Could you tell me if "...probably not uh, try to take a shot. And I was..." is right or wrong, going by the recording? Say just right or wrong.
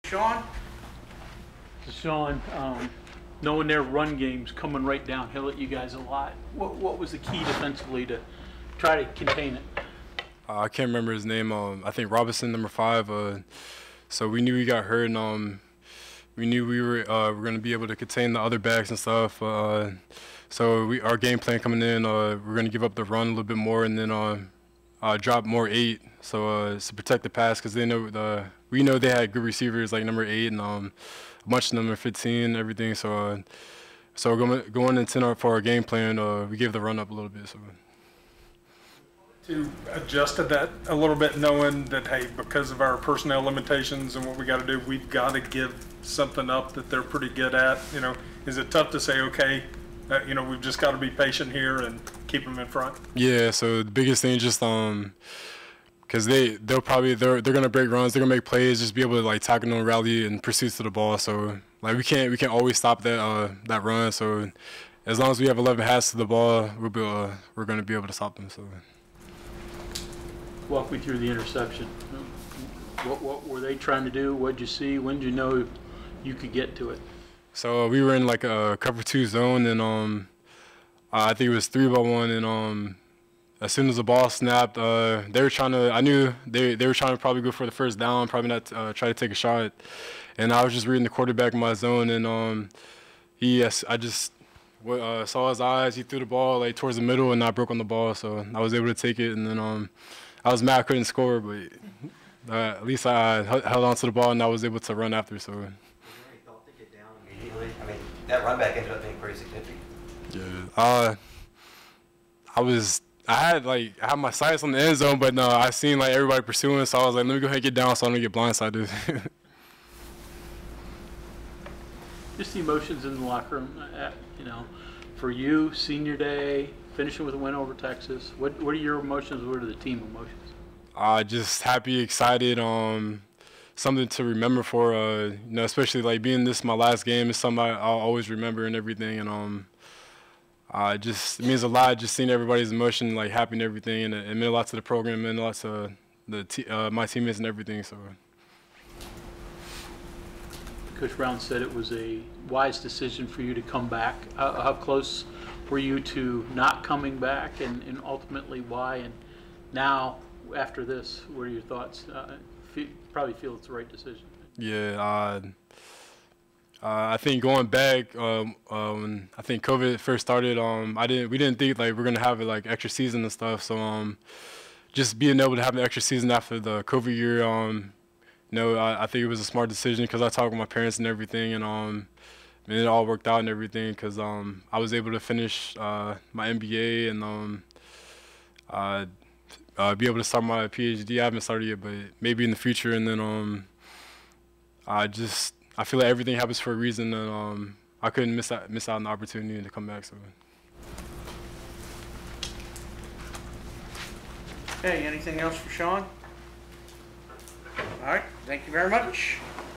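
right.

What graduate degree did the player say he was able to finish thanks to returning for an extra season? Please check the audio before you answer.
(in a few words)
MBA.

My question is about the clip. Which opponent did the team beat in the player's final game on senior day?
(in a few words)
Texas.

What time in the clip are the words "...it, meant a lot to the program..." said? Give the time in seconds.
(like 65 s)
144 s.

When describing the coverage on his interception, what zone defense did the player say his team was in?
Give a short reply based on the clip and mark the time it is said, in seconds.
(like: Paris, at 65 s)
Cover two, at 78 s.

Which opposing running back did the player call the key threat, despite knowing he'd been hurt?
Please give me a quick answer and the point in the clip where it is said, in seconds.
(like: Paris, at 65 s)
Robinson, at 12 s.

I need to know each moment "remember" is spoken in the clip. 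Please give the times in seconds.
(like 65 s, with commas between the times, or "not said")
10 s, 134 s, 138 s.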